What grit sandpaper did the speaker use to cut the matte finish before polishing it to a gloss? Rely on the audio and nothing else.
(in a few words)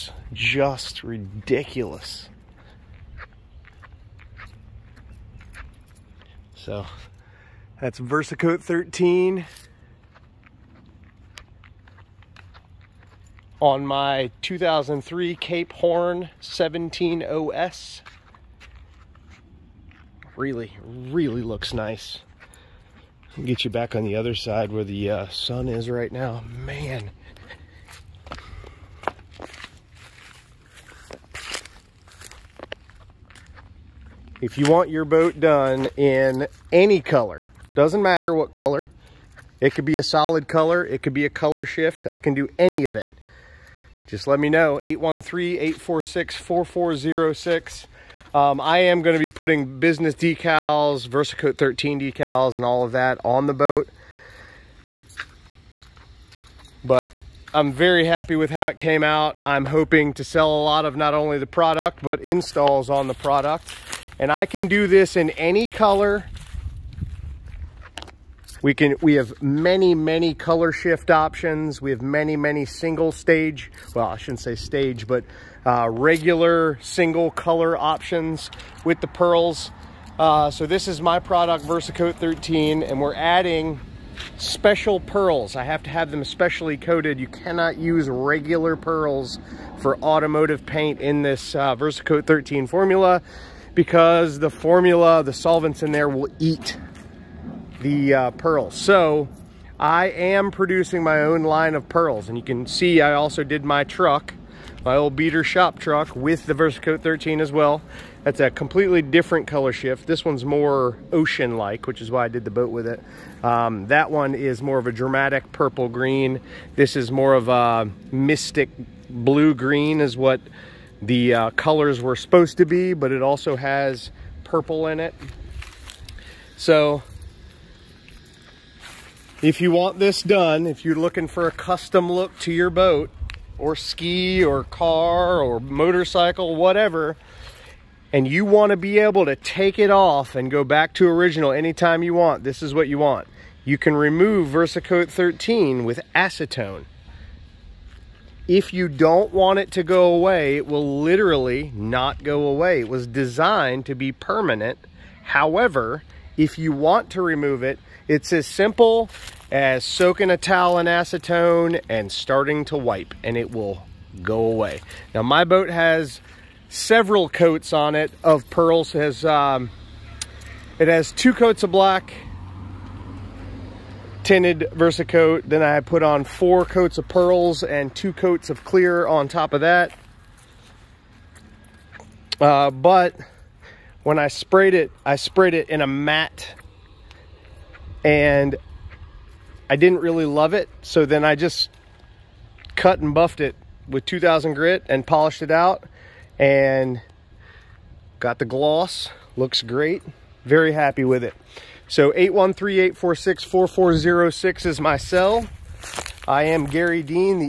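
2000 grit.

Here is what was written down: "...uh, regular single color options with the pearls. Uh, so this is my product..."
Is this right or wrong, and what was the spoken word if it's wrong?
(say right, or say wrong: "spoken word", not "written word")
right.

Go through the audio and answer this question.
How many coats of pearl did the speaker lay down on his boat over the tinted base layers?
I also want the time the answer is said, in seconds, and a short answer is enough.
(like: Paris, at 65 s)
4, at 176 s.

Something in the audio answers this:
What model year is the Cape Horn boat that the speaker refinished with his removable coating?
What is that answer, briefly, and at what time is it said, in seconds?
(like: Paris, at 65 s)
2003, at 14 s.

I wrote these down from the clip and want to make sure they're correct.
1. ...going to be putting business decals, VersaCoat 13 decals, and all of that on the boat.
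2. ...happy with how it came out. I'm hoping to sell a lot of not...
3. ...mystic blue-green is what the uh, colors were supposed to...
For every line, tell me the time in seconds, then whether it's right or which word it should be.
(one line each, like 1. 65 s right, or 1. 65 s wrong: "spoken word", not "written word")
1. 49 s right
2. 58 s right
3. 118 s right.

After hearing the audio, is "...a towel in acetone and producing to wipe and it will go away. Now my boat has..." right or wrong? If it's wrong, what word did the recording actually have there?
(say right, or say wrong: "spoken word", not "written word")
wrong: "starting", not "producing".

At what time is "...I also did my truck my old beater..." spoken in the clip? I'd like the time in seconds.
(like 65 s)
102 s.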